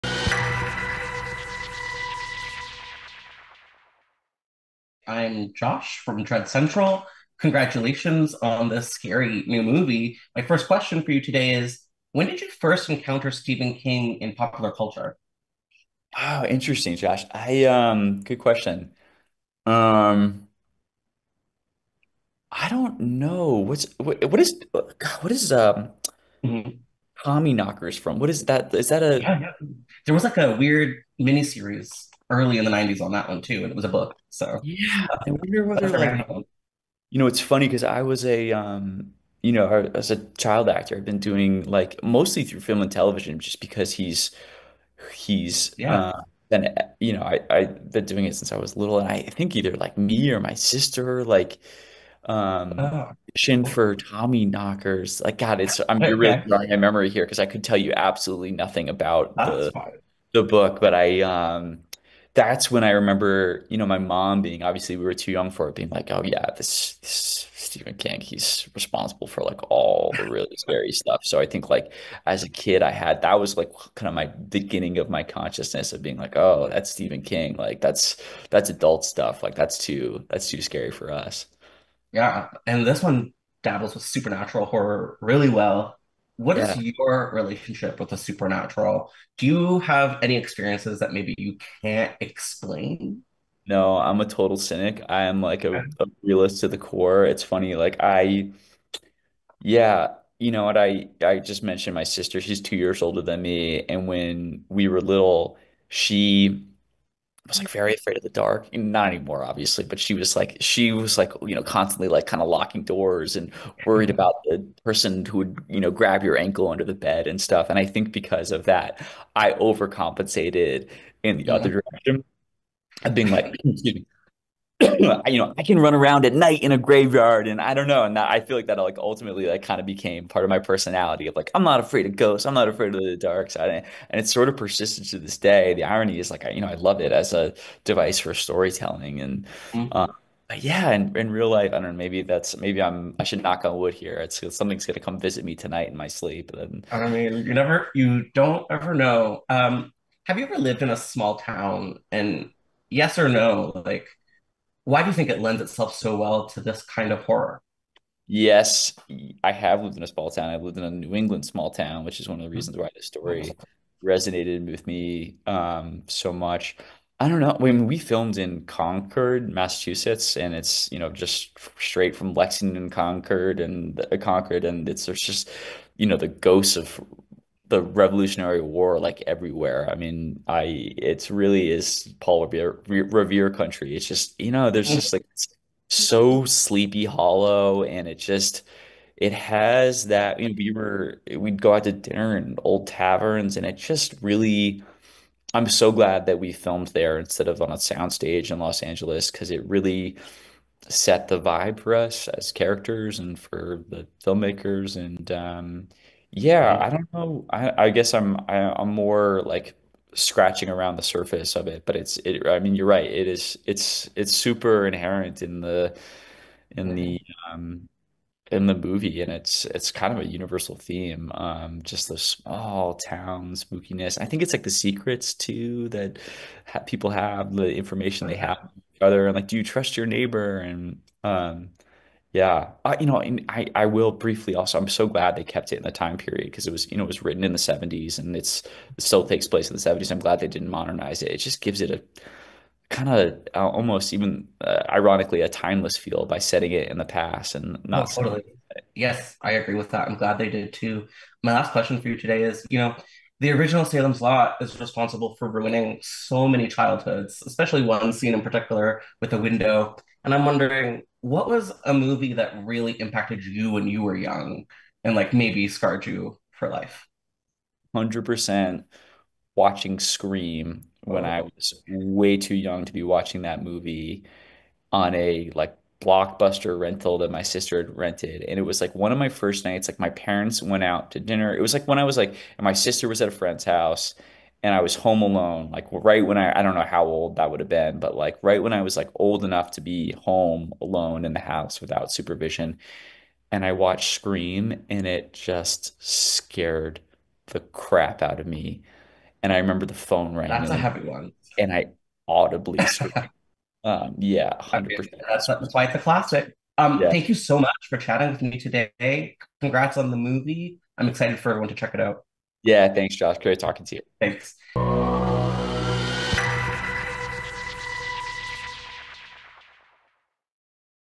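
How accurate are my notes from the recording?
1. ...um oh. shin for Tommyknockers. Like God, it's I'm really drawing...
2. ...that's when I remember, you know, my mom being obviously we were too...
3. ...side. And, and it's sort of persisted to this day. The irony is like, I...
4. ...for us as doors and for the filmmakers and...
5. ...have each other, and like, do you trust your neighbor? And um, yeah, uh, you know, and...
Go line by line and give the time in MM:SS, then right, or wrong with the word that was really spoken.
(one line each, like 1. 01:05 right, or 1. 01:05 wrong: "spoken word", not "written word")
1. 00:52 right
2. 01:02 right
3. 02:13 right
4. 03:21 wrong: "characters", not "doors"
5. 03:48 right.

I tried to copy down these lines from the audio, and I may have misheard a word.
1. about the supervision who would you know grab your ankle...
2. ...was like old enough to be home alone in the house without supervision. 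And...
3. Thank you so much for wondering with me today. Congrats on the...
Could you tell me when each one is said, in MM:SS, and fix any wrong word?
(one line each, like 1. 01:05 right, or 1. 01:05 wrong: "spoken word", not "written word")
1. 01:54 wrong: "person", not "supervision"
2. 04:48 right
3. 05:07 wrong: "chatting", not "wondering".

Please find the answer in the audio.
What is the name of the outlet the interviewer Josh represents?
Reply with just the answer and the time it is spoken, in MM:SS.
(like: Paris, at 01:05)
Dread Central, at 00:06.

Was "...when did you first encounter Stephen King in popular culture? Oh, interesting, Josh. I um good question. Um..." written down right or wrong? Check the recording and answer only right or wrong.
right.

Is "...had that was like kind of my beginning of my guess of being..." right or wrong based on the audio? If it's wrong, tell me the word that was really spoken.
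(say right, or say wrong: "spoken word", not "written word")
wrong: "consciousness", not "guess".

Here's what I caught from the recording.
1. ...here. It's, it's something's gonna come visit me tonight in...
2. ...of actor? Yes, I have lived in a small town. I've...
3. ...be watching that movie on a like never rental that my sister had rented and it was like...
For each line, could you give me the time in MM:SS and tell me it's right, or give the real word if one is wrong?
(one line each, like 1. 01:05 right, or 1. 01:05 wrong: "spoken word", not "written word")
1. 02:23 right
2. 02:37 wrong: "horror", not "actor"
3. 04:32 wrong: "blockbuster", not "never".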